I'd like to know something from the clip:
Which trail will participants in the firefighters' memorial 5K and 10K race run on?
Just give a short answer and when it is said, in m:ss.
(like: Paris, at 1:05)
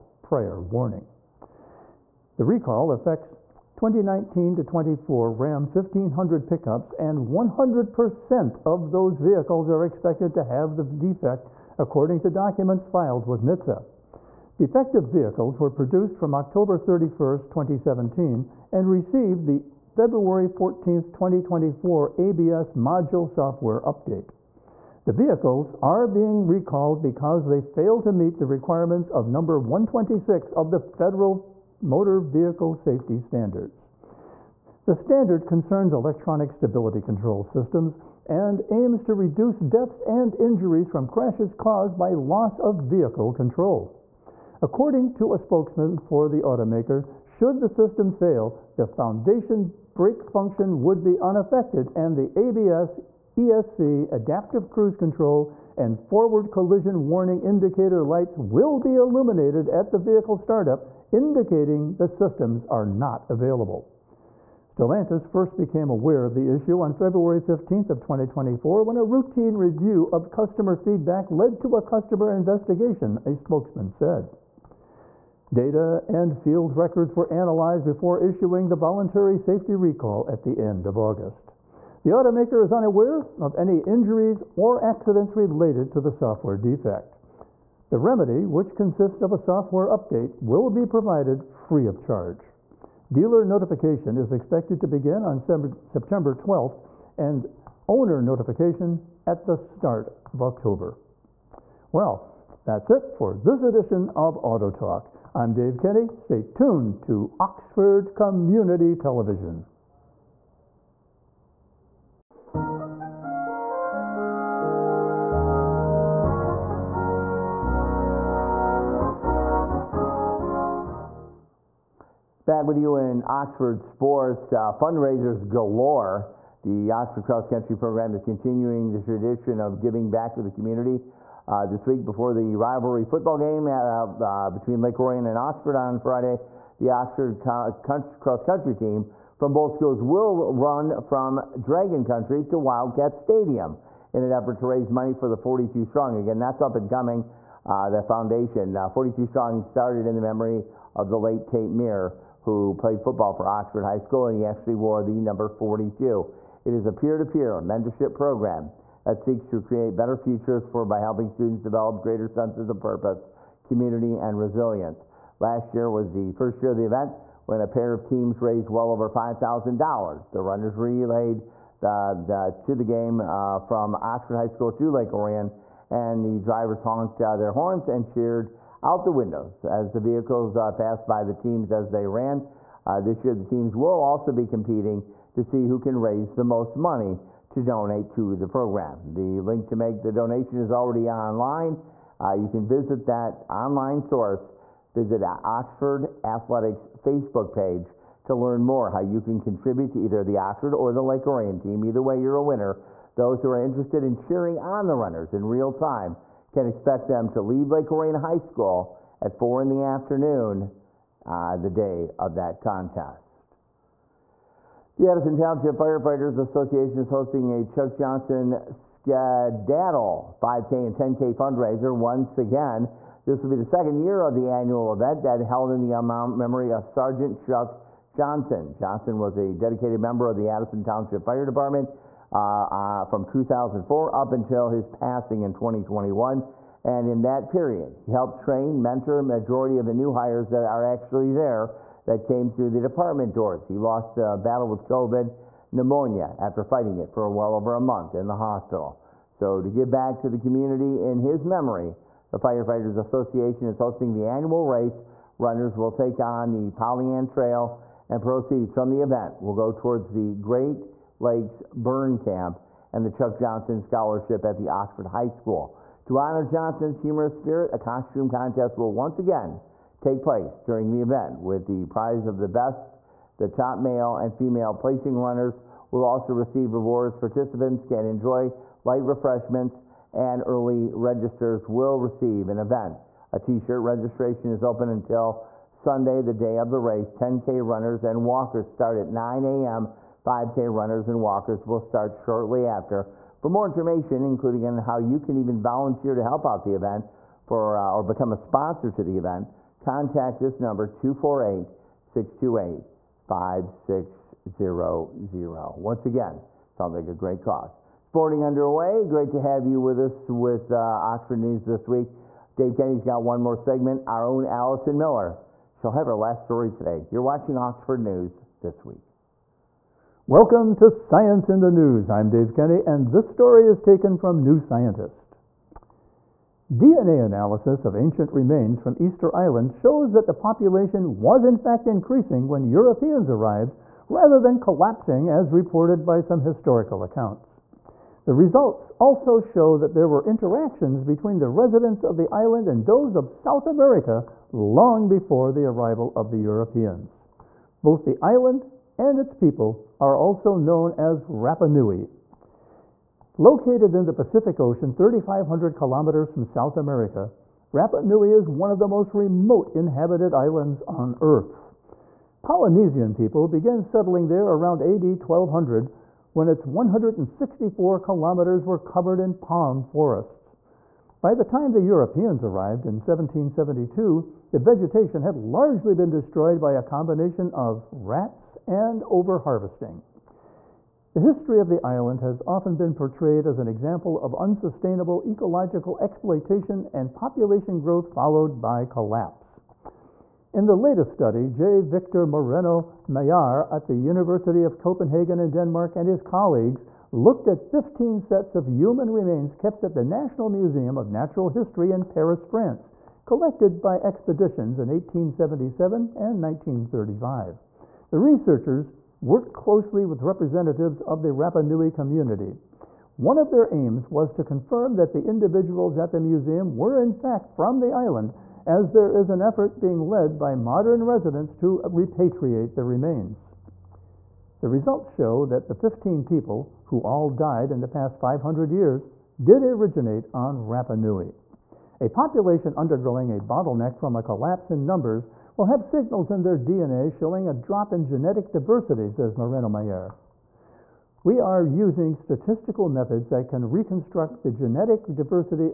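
Polly Ann Trail, at 4:16.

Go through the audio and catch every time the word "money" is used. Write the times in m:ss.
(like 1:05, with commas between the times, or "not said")
2:24, 3:06.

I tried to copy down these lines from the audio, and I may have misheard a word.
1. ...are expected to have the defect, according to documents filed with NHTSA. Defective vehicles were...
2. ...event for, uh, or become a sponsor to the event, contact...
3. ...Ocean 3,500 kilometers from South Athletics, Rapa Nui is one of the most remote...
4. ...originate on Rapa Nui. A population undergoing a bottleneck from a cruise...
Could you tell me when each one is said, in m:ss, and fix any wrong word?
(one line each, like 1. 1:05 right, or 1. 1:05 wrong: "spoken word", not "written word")
1. 0:09 right
2. 4:56 right
3. 5:54 wrong: "America", not "Athletics"
4. 7:09 wrong: "collapse", not "cruise".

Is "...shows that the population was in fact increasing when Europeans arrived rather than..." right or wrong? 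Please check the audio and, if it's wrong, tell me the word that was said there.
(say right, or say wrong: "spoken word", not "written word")
right.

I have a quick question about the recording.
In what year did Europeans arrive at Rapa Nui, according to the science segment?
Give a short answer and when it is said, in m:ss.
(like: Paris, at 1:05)
1772, at 6:12.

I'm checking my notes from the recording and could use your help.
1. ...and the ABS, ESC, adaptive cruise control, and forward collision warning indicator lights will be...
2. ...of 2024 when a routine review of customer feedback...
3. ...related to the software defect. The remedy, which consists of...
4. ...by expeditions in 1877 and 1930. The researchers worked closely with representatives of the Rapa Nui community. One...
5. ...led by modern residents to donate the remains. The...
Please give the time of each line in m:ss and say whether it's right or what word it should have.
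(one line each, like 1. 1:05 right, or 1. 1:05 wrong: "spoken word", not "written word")
1. 0:51 right
2. 1:07 right
3. 1:25 right
4. 6:43 wrong: "1935", not "1930"
5. 7:00 wrong: "repatriate", not "donate".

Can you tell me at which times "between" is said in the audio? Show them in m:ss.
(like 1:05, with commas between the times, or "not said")
2:14, 5:41.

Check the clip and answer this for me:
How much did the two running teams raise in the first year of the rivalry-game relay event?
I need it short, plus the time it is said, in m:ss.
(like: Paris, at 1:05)
over $5,000, at 2:48.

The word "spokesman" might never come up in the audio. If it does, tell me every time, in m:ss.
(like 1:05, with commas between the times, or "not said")
0:45, 1:13.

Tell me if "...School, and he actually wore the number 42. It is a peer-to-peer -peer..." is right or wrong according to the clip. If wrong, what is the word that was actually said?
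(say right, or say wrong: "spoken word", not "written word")
right.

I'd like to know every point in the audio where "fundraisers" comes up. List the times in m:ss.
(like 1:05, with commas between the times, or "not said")
2:04, 3:41.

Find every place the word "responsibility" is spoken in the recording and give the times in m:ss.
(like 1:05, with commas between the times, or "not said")
not said.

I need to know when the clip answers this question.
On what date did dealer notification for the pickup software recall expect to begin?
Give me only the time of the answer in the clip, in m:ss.
1:35.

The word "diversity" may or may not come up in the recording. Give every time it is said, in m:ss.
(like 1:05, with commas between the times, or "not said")
7:18, 7:25.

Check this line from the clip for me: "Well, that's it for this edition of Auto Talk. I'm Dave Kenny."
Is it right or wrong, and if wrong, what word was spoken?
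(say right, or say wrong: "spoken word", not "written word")
right.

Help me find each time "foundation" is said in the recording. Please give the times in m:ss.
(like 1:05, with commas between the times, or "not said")
0:48, 2:28.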